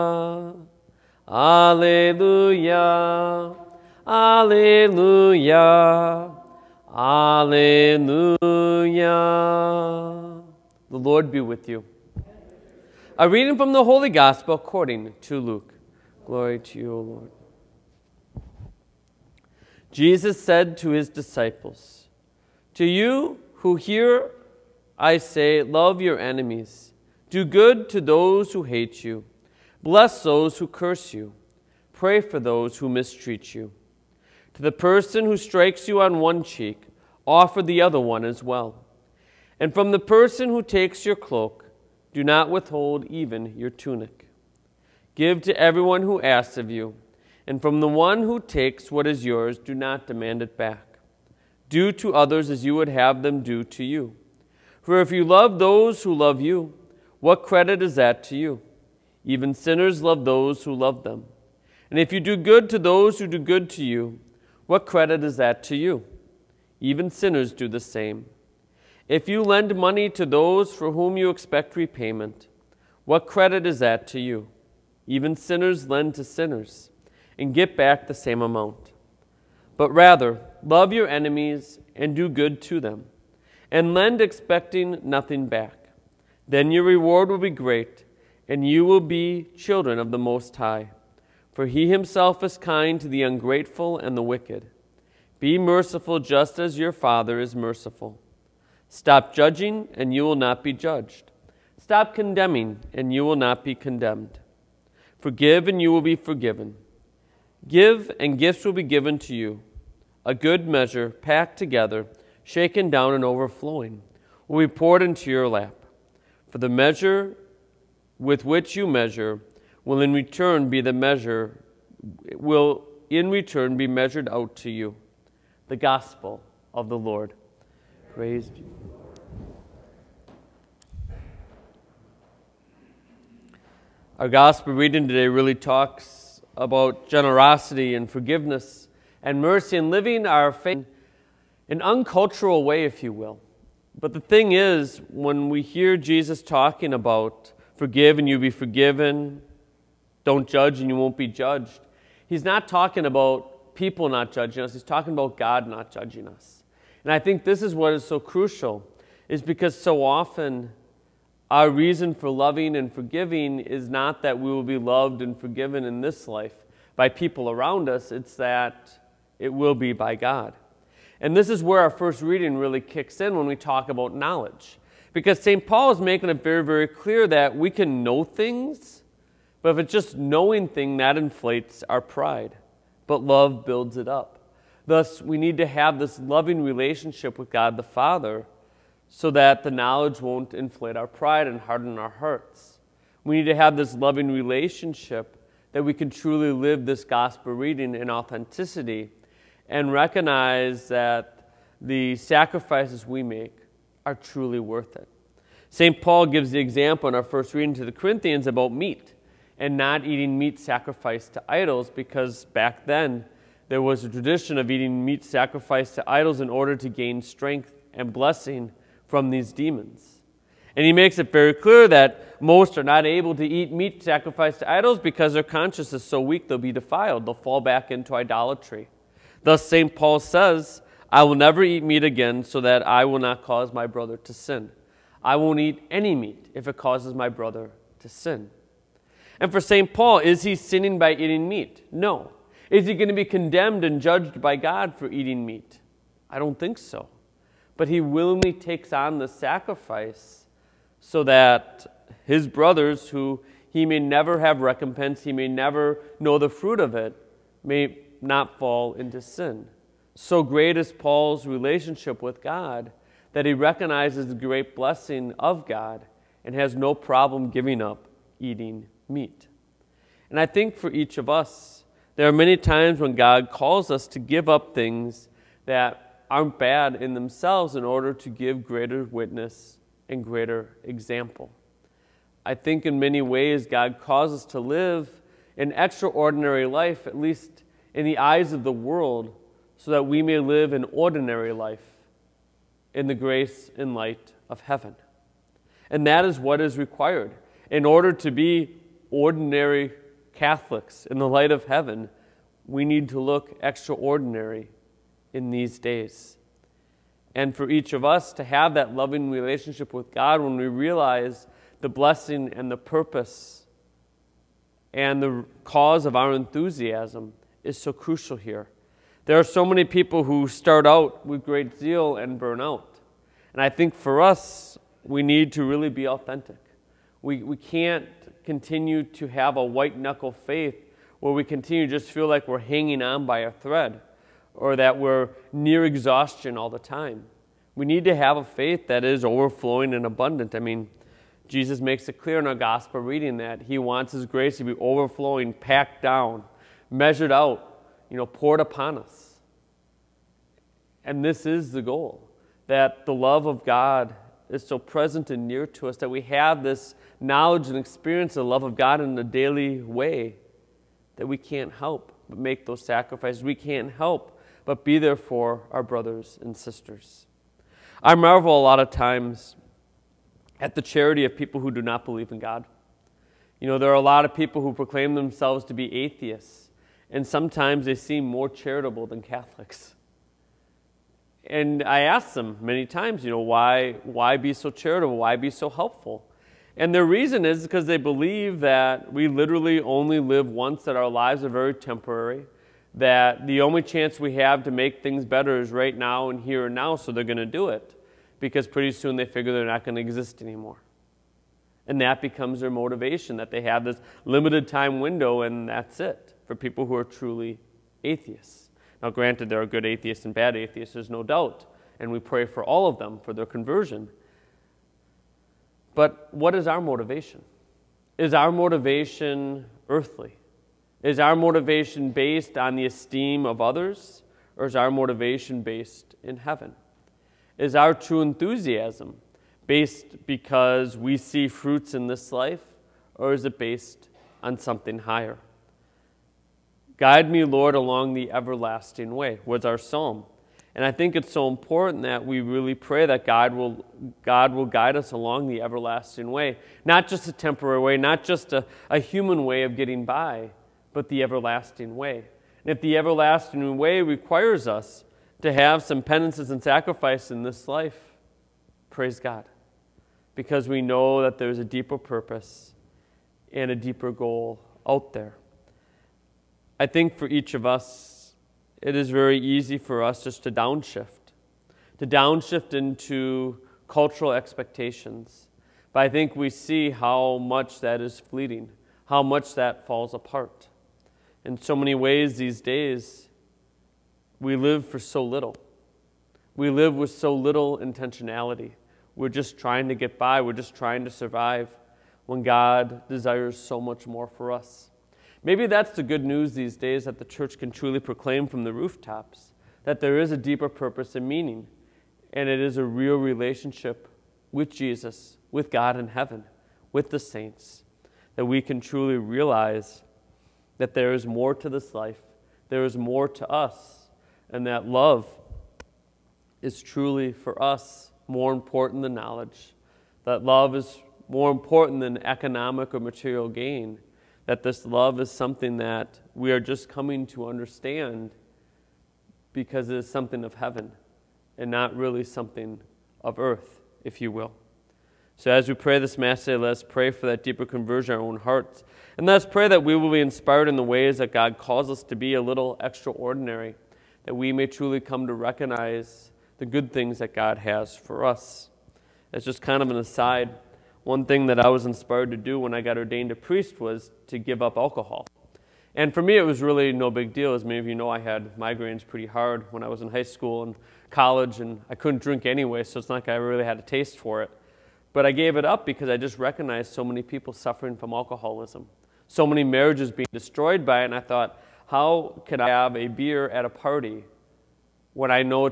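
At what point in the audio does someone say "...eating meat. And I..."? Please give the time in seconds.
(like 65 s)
268 s.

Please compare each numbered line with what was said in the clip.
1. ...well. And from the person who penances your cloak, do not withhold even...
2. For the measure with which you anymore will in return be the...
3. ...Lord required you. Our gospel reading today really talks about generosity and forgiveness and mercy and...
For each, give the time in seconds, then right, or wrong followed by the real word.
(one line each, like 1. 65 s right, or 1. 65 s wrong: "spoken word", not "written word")
1. 38 s wrong: "takes", not "penances"
2. 116 s wrong: "measure", not "anymore"
3. 126 s wrong: "praised", not "required".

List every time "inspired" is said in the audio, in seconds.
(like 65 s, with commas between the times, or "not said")
540 s, 551 s.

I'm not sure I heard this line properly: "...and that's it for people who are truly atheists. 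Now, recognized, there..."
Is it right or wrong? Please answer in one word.
wrong.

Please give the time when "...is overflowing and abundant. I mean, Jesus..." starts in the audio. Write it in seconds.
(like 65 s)
339 s.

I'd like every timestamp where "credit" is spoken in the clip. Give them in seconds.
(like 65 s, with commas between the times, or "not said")
57 s, 64 s, 73 s.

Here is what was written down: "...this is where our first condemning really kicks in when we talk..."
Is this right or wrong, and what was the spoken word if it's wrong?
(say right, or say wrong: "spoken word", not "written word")
wrong: "reading", not "condemning".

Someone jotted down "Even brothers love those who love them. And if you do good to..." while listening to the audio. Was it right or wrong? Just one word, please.
wrong.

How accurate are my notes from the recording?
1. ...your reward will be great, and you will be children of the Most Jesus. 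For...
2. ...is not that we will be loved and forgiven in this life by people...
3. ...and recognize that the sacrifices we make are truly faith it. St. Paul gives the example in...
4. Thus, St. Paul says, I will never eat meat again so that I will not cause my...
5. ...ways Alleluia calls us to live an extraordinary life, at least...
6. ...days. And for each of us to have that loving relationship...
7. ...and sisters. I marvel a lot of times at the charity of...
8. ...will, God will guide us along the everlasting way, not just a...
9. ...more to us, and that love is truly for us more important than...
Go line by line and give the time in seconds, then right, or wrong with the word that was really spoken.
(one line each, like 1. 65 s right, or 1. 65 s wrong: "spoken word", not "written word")
1. 86 s wrong: "High", not "Jesus"
2. 163 s right
3. 199 s wrong: "worth", not "faith"
4. 229 s right
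5. 283 s wrong: "God", not "Alleluia"
6. 305 s right
7. 366 s right
8. 443 s right
9. 512 s right.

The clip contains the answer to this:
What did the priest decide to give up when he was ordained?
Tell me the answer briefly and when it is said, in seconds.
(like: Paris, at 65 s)
alcohol, at 554 s.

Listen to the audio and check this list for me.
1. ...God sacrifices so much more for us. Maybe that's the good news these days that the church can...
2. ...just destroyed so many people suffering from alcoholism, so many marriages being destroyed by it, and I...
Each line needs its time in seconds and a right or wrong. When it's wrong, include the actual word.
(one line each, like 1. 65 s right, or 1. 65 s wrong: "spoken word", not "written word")
1. 492 s wrong: "desires", not "sacrifices"
2. 566 s wrong: "recognized", not "destroyed".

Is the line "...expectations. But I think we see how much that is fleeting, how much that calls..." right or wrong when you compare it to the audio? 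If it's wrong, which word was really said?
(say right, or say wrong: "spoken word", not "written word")
wrong: "falls", not "calls".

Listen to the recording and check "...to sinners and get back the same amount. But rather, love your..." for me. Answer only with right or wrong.
right.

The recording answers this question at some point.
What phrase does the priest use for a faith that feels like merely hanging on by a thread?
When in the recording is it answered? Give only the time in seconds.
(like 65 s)
329 s.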